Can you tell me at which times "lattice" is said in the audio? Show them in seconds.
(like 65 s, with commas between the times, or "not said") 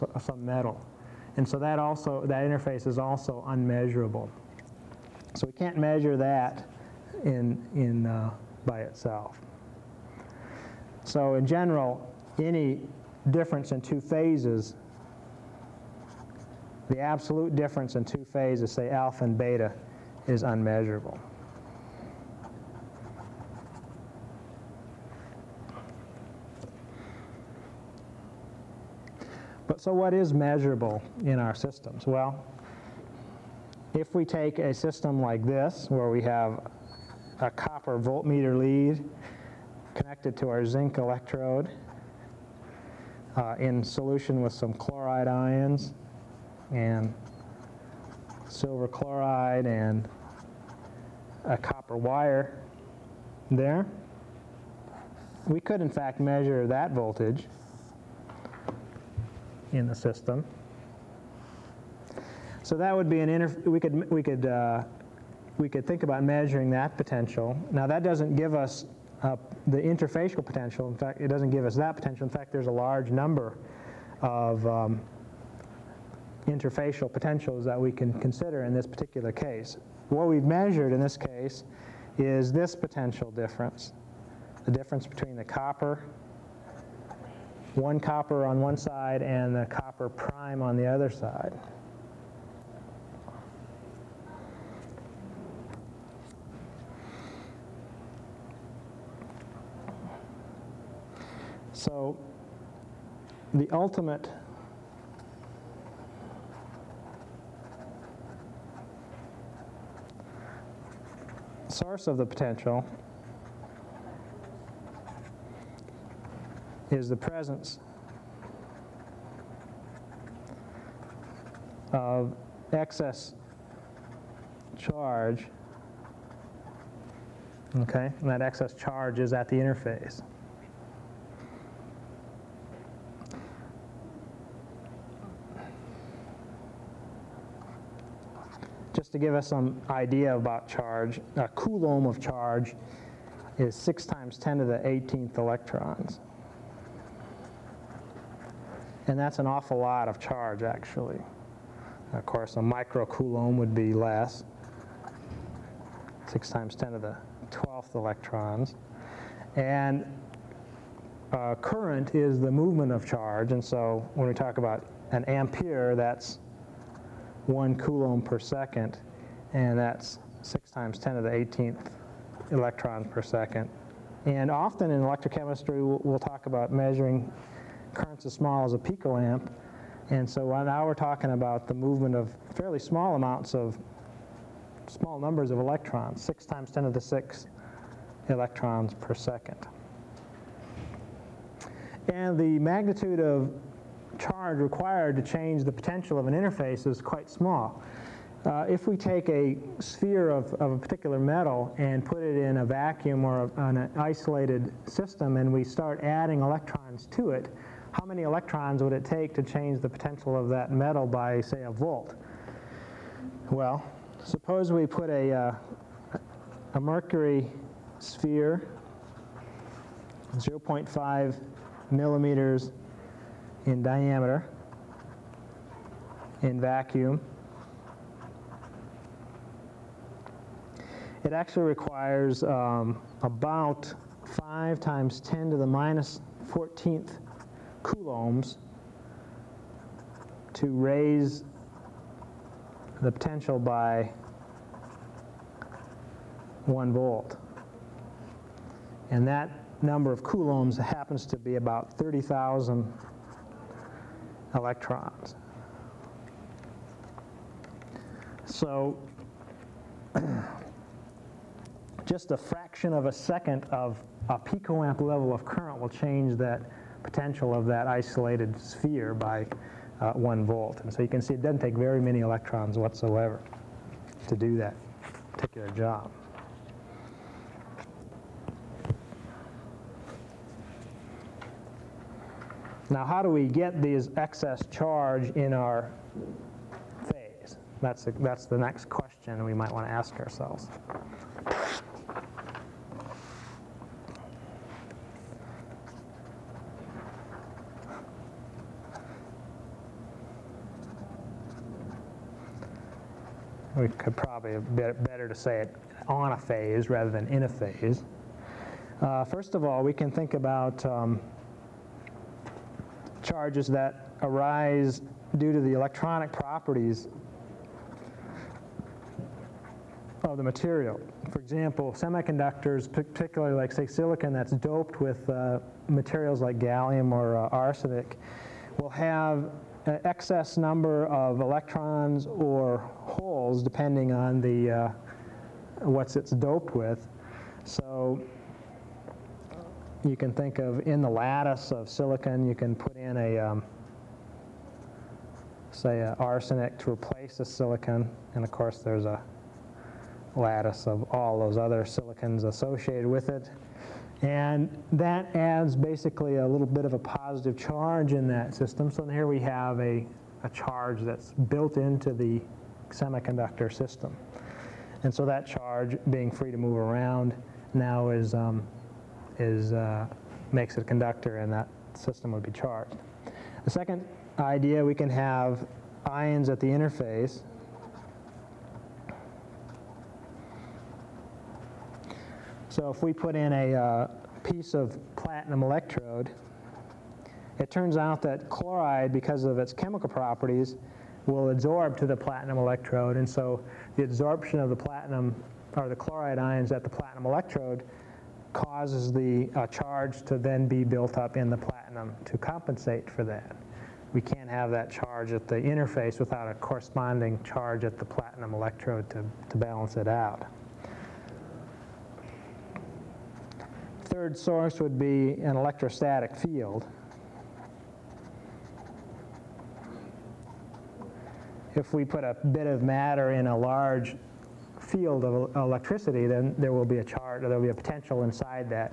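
341 s, 350 s.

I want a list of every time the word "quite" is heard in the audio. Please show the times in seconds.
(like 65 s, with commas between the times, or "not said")
196 s.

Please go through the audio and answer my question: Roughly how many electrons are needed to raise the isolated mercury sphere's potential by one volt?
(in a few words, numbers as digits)
30,000.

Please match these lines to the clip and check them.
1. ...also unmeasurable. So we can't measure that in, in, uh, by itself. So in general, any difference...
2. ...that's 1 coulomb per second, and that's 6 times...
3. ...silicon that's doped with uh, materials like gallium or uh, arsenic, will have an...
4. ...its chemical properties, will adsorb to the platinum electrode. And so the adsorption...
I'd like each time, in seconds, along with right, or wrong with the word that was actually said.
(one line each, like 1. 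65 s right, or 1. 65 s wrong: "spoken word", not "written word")
1. 2 s right
2. 165 s right
3. 323 s right
4. 389 s right.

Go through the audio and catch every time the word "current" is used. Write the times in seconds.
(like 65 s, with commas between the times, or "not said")
161 s, 177 s, 265 s.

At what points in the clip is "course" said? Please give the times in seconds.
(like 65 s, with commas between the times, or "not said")
152 s, 348 s.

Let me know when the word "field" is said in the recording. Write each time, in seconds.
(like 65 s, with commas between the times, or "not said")
416 s, 424 s.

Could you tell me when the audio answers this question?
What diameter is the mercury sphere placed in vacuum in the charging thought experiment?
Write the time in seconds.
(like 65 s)
220 s.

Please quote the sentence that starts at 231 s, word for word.
It actually requires um, about 5 times 10 to the minus 14th coulombs to raise the potential by one volt.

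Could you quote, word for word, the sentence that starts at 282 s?
Now, how do we get these excess charge in our phase?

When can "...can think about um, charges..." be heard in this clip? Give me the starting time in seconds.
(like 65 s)
309 s.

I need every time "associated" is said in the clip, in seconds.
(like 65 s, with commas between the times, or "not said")
352 s.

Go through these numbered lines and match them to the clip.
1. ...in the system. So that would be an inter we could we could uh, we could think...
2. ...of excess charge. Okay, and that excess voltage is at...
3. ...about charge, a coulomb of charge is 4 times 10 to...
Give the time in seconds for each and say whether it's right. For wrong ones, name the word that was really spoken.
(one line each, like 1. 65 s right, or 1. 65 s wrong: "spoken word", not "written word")
1. 59 s right
2. 121 s wrong: "charge", not "voltage"
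3. 140 s wrong: "6", not "4".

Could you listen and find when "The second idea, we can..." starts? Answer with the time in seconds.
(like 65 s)
373 s.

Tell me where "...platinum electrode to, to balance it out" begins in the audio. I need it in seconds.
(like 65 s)
408 s.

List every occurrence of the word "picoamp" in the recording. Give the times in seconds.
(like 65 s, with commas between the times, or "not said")
178 s, 264 s.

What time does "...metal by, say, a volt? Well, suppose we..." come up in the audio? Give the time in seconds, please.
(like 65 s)
210 s.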